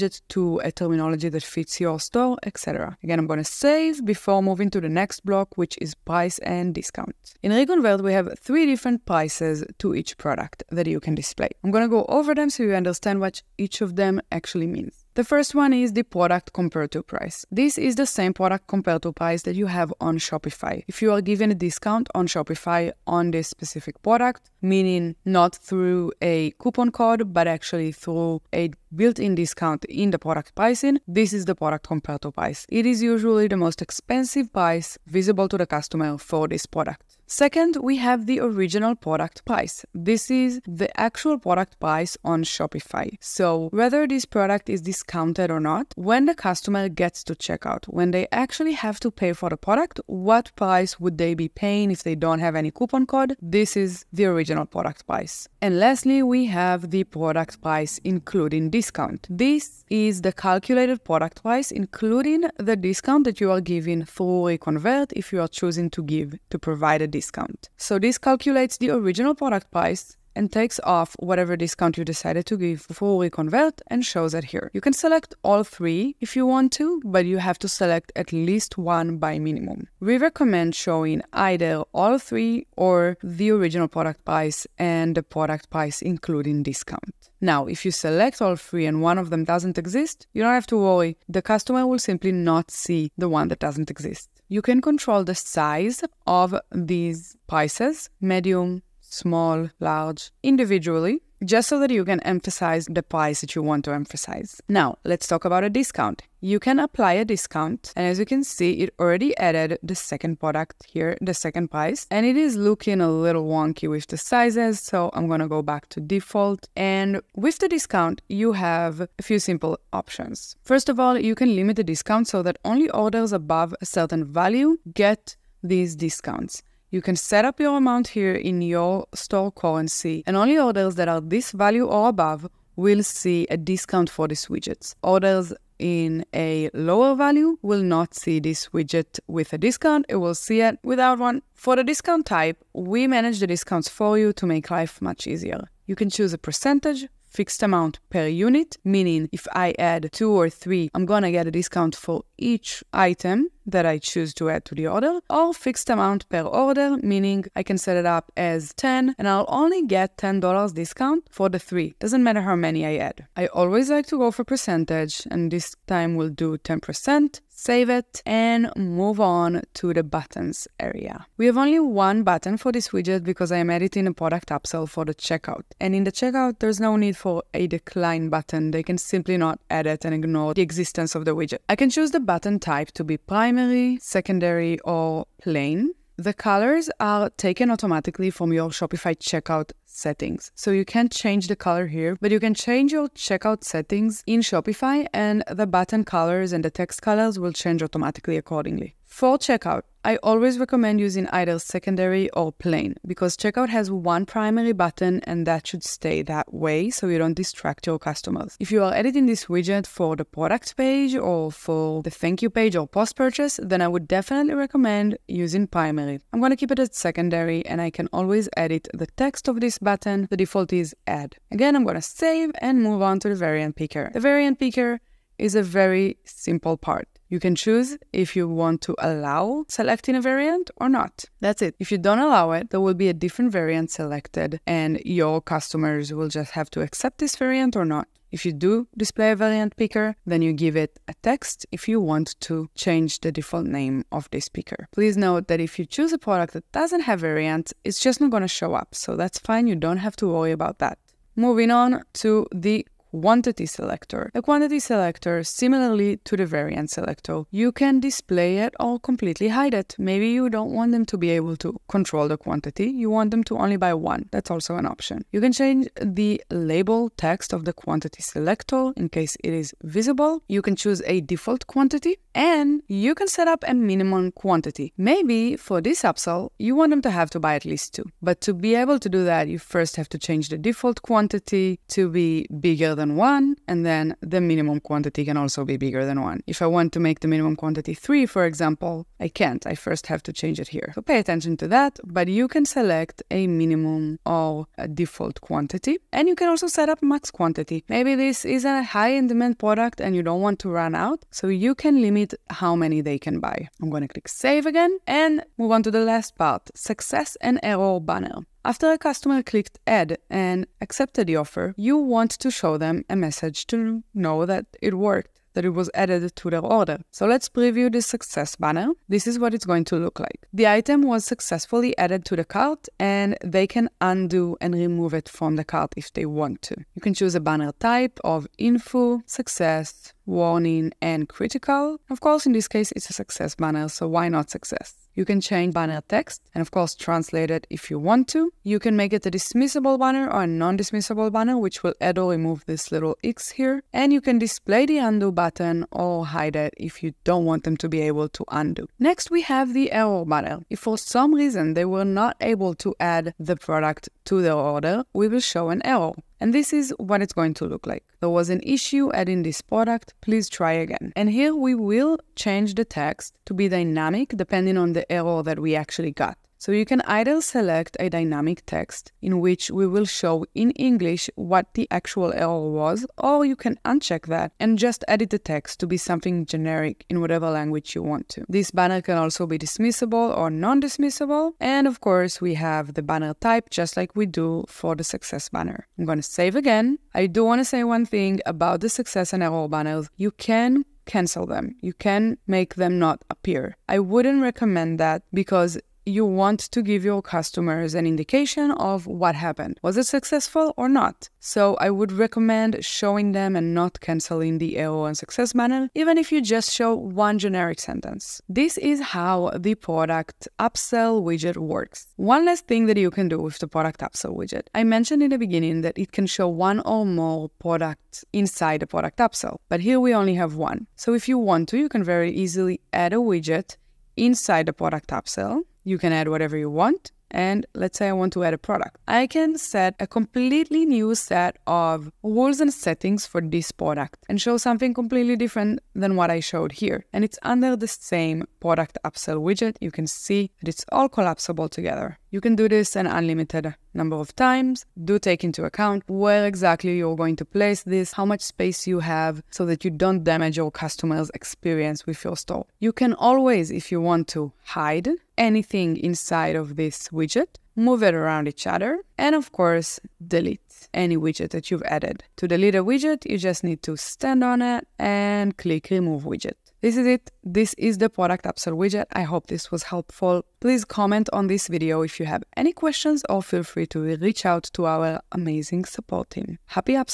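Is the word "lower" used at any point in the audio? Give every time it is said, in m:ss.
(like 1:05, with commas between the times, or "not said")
2:16.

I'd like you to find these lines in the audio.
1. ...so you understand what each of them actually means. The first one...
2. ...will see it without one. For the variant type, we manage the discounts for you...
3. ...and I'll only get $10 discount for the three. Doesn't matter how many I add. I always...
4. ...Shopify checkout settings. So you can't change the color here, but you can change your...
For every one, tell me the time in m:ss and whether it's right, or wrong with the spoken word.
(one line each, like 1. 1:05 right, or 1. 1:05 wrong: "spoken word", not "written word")
1. 0:12 right
2. 2:20 wrong: "discount", not "variant"
3. 2:39 right
4. 3:08 right.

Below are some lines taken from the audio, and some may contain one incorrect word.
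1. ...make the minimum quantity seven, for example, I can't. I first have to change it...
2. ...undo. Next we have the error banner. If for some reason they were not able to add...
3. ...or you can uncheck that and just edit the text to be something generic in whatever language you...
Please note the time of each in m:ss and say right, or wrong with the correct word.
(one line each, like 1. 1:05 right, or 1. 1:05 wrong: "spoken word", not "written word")
1. 4:46 wrong: "three", not "seven"
2. 5:48 right
3. 6:13 right.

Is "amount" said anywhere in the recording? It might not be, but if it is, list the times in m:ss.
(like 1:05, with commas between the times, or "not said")
2:07, 2:27, 2:35.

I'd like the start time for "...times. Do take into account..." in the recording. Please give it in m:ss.
7:24.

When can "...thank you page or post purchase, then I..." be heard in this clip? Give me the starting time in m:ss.
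3:32.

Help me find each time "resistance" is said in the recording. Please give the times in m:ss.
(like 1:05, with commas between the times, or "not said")
not said.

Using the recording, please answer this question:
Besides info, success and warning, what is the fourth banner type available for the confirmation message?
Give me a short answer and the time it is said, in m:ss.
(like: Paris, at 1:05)
critical, at 5:31.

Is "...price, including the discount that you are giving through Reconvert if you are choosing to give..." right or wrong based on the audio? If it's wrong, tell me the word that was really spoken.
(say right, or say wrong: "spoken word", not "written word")
right.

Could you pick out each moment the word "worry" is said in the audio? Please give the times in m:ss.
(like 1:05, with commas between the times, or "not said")
1:30, 4:10.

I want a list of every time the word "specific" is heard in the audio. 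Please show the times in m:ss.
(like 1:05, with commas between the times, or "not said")
0:23.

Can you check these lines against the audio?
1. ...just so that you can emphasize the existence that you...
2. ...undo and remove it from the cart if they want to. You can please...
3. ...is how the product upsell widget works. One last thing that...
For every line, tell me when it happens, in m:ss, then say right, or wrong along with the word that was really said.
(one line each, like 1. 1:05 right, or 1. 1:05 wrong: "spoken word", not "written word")
1. 1:41 wrong: "price", not "existence"
2. 5:24 wrong: "choose", not "please"
3. 6:48 right.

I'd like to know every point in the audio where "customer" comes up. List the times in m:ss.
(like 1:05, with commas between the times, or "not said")
0:35, 0:46, 1:31, 3:27, 3:55, 5:08, 6:37, 7:30.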